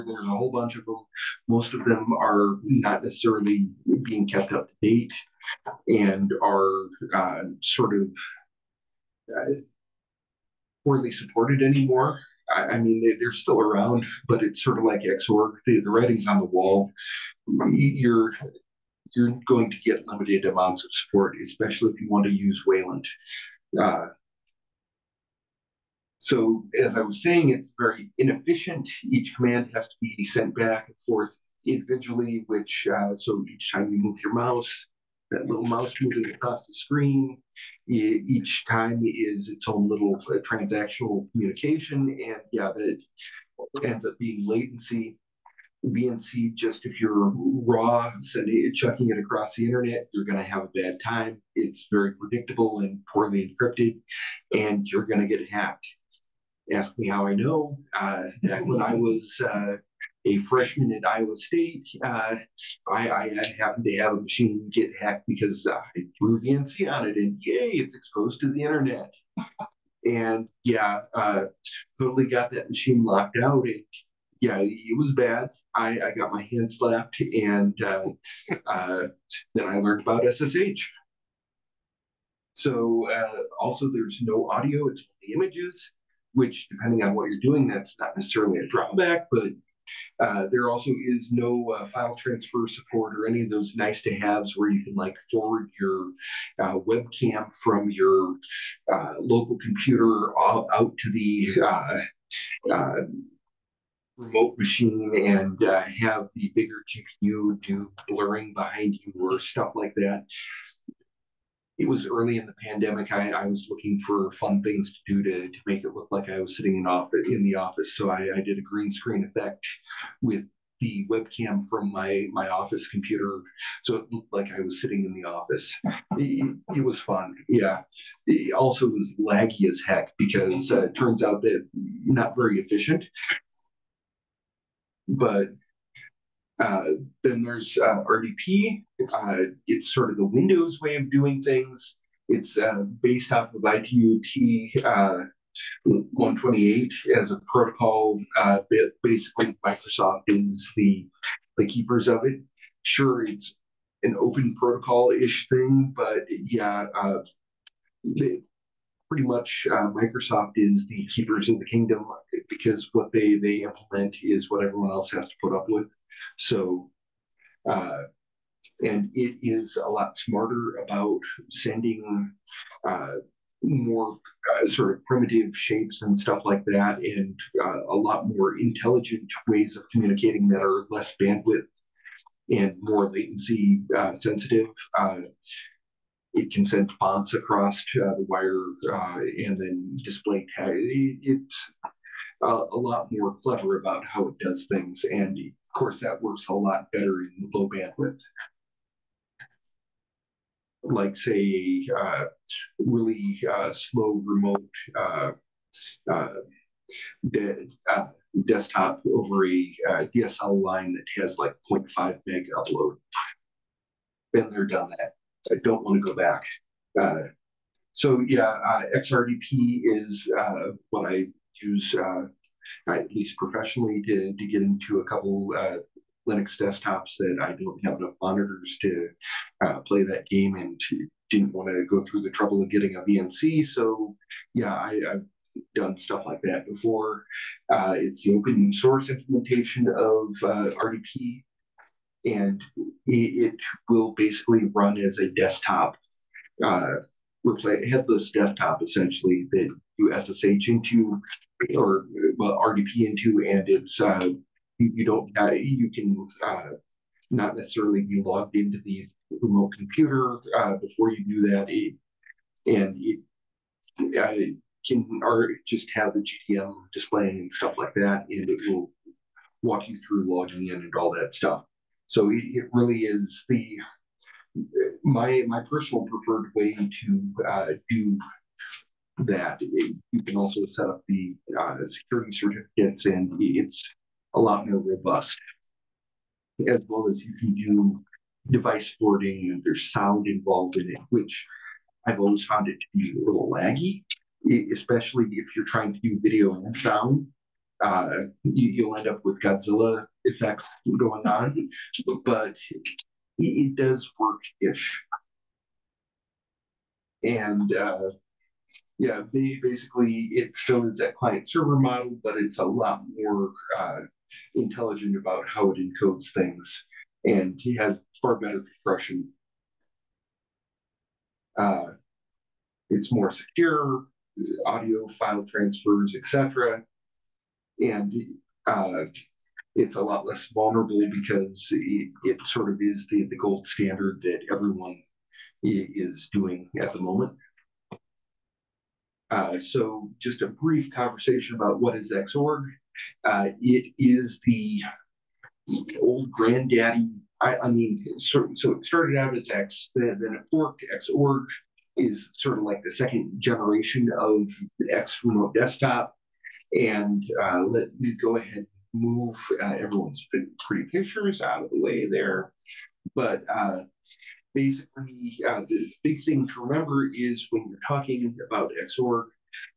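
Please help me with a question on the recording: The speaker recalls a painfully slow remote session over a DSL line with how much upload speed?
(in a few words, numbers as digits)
0.5 meg.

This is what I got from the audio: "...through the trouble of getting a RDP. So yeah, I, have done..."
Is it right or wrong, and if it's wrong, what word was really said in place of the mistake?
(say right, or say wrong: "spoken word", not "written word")
wrong: "VNC", not "RDP".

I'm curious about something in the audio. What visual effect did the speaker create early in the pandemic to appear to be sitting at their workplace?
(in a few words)
green screen.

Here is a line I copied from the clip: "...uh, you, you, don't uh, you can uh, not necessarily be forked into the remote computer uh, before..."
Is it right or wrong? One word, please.
wrong.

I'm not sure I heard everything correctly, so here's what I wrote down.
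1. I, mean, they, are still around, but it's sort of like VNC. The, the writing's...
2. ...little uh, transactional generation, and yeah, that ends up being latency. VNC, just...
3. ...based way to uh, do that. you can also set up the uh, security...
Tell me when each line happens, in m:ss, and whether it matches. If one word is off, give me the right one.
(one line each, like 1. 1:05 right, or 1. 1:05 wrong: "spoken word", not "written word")
1. 0:12 wrong: "Xorg", not "VNC"
2. 0:39 wrong: "communication", not "generation"
3. 4:36 wrong: "preferred", not "based".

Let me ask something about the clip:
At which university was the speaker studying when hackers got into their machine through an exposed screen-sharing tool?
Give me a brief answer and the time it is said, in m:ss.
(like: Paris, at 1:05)
Iowa State, at 1:01.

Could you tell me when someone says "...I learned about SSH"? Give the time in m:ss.
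1:19.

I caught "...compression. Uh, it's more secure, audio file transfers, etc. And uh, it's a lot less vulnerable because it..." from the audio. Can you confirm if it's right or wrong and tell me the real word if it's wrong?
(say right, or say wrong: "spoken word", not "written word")
right.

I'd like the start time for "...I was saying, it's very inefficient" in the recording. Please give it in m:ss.
0:26.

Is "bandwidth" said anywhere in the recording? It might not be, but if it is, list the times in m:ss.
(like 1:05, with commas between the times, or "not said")
3:01, 3:17.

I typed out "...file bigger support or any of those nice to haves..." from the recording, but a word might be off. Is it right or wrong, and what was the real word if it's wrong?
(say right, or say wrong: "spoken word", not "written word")
wrong: "transfer", not "bigger".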